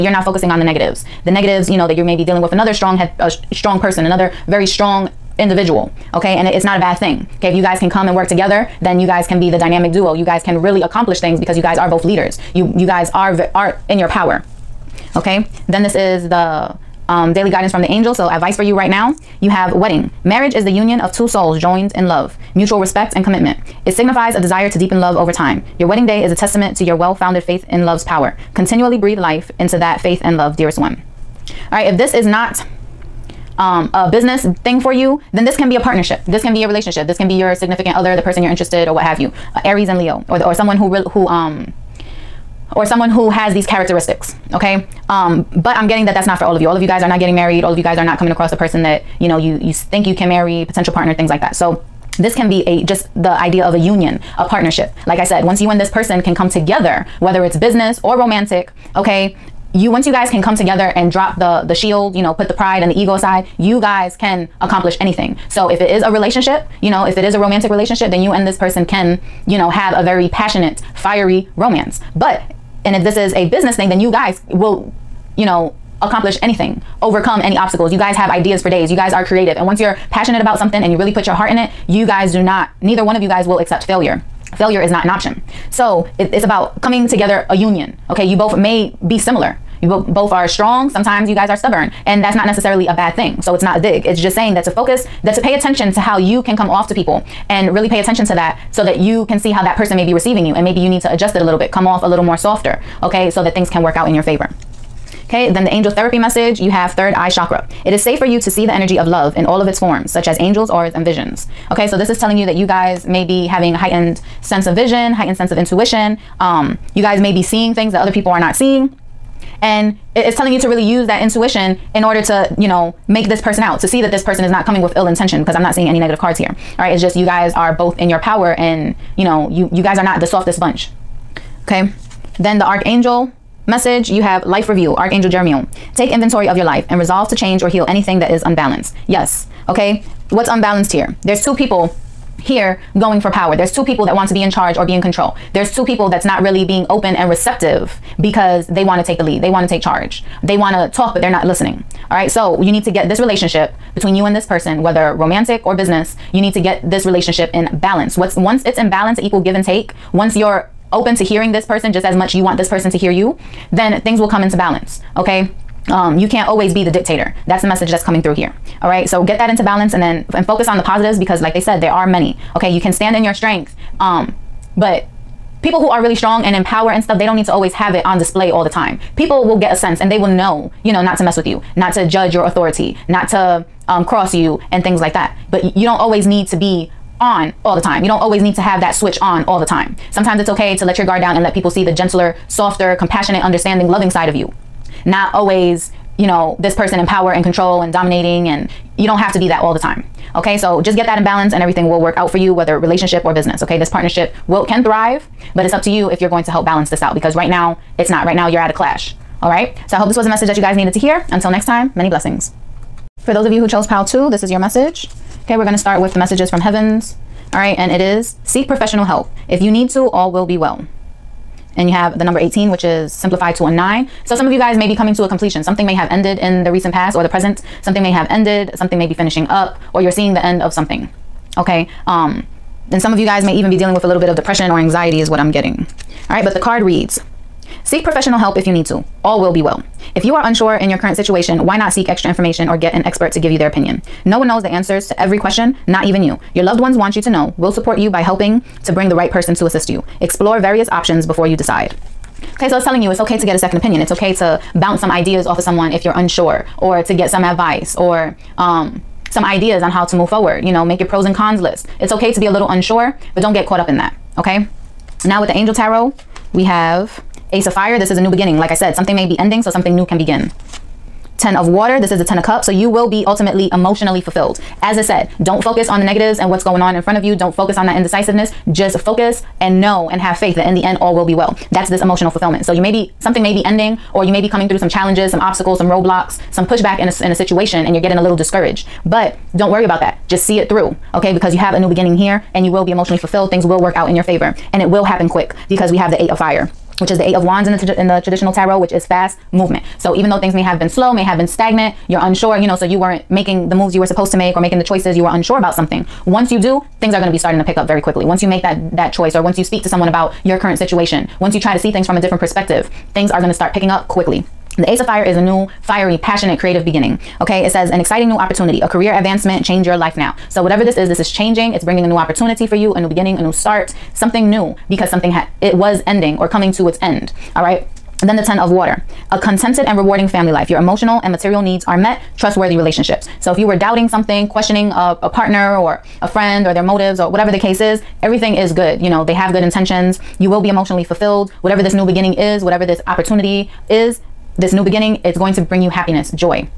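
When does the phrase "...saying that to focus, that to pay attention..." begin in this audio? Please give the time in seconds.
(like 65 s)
94 s.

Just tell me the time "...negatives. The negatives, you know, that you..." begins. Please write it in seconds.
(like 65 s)
0 s.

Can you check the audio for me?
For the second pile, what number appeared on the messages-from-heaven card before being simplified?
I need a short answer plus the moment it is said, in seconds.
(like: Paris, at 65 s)
18, at 222 s.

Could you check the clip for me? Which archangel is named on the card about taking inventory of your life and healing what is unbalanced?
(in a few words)
Jeremiah.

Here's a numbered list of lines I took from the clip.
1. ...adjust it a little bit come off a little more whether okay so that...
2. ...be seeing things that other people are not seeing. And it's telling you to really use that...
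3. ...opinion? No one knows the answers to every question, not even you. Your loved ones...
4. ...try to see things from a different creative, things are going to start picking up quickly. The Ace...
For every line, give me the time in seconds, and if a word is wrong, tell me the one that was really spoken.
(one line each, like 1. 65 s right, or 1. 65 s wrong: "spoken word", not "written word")
1. 101 s wrong: "softer", not "whether"
2. 117 s right
3. 243 s right
4. 311 s wrong: "perspective", not "creative".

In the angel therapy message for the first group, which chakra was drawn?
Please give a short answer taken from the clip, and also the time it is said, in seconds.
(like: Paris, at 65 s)
Third eye chakra, at 106 s.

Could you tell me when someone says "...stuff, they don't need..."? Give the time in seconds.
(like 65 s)
177 s.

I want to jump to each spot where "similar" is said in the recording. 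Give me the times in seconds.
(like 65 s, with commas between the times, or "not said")
89 s.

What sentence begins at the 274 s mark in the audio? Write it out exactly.
As I said, don't focus on the negatives and what's going on in front of you.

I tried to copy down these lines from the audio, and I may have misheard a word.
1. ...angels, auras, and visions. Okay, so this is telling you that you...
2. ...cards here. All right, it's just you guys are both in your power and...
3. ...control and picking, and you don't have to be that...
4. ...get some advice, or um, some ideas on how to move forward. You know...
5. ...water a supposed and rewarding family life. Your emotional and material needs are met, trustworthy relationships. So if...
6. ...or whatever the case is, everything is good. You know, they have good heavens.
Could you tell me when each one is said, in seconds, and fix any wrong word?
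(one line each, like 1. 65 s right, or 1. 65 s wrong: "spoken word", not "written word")
1. 110 s right
2. 126 s right
3. 197 s wrong: "dominating", not "picking"
4. 257 s right
5. 328 s wrong: "contented", not "supposed"
6. 337 s wrong: "intentions", not "heavens".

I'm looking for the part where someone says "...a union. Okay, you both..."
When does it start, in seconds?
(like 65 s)
87 s.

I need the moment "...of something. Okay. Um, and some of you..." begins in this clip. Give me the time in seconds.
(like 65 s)
230 s.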